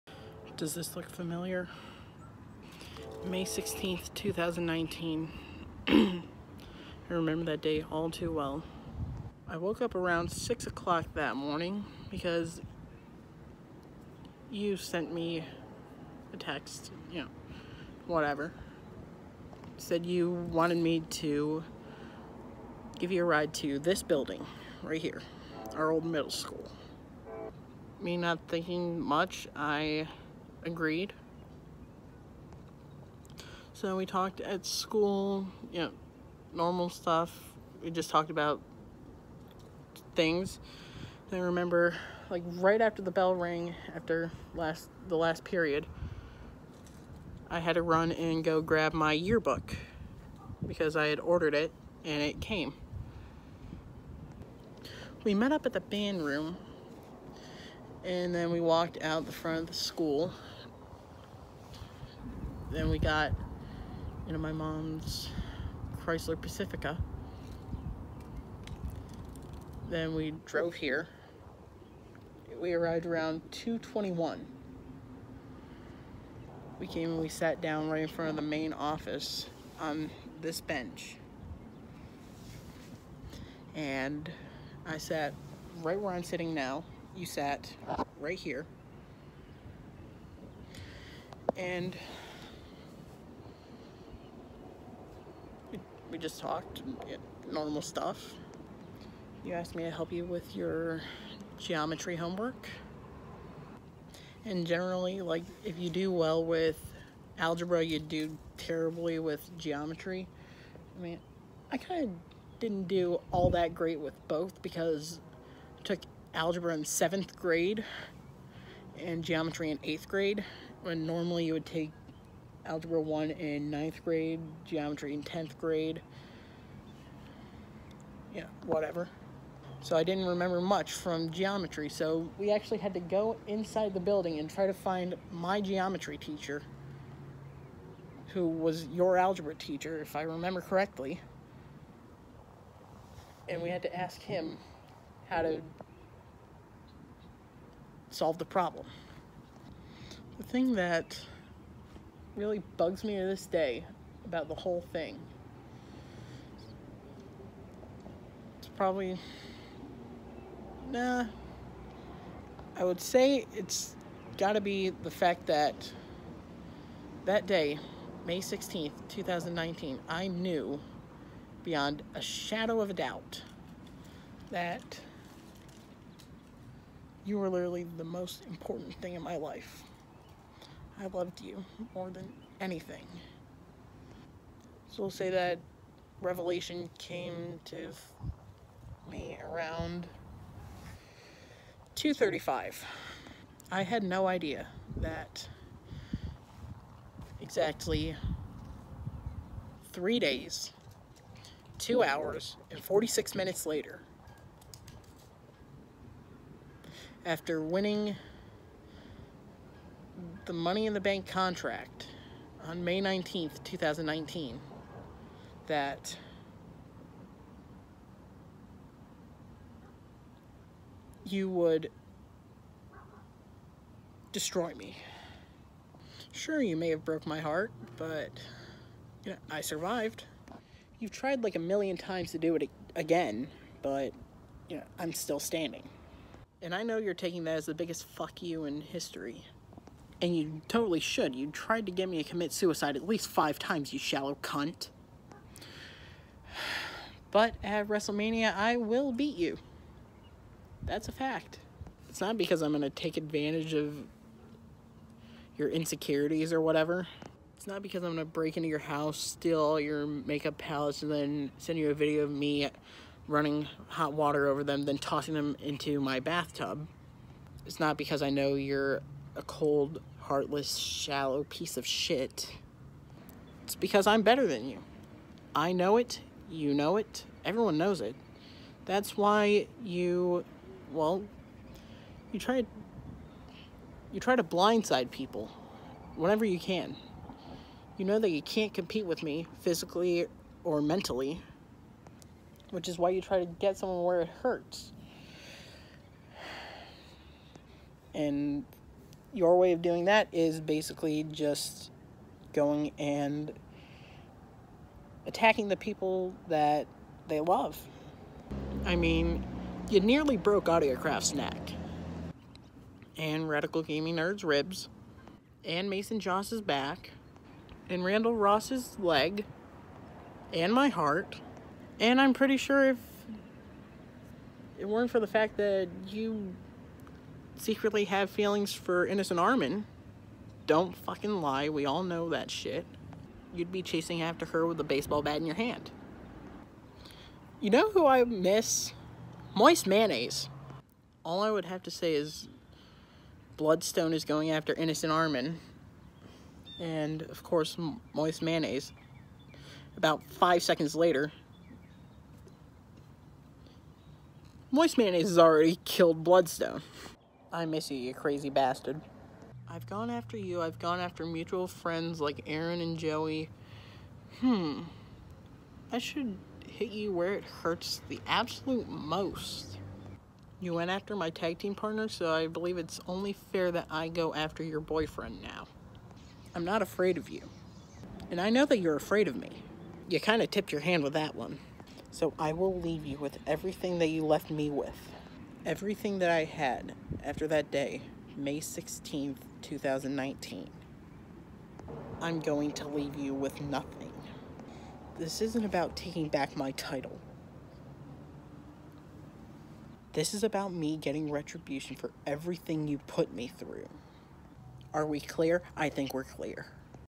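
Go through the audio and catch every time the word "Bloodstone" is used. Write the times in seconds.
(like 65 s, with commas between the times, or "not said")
343 s, 356 s.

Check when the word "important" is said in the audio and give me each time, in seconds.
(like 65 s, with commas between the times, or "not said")
178 s.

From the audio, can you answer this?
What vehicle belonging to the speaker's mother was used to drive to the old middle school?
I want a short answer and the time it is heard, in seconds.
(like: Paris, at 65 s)
Chrysler Pacifica, at 66 s.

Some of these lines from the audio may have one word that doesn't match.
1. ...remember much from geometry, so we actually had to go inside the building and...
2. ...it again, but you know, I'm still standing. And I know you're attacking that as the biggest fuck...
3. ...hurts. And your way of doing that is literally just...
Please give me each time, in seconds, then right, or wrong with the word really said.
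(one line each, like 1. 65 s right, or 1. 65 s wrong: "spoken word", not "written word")
1. 130 s right
2. 232 s wrong: "taking", not "attacking"
3. 294 s wrong: "basically", not "literally".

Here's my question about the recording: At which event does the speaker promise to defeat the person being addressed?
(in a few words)
WrestleMania.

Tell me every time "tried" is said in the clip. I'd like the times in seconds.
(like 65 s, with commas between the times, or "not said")
231 s, 241 s.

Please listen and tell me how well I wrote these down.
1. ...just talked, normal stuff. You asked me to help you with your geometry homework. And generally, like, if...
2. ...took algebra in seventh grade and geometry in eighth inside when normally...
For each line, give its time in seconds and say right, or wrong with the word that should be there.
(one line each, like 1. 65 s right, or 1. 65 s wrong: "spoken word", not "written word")
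1. 96 s right
2. 115 s wrong: "grade", not "inside".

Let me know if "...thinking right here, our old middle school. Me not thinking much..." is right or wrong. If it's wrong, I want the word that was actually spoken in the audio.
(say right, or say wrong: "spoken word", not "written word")
wrong: "building", not "thinking".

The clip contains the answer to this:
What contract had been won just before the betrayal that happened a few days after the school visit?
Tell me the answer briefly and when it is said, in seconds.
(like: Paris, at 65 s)
Money in the Bank, at 210 s.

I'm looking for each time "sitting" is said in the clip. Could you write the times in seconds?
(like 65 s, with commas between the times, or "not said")
86 s.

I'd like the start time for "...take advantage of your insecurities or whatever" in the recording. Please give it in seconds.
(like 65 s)
252 s.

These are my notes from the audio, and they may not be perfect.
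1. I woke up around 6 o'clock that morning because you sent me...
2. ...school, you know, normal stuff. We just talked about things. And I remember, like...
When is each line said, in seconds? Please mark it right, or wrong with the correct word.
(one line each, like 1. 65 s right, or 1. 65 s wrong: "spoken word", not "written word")
1. 9 s right
2. 34 s right.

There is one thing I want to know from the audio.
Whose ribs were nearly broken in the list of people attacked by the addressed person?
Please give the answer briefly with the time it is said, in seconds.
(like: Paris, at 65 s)
Radical Gaming Nerd, at 313 s.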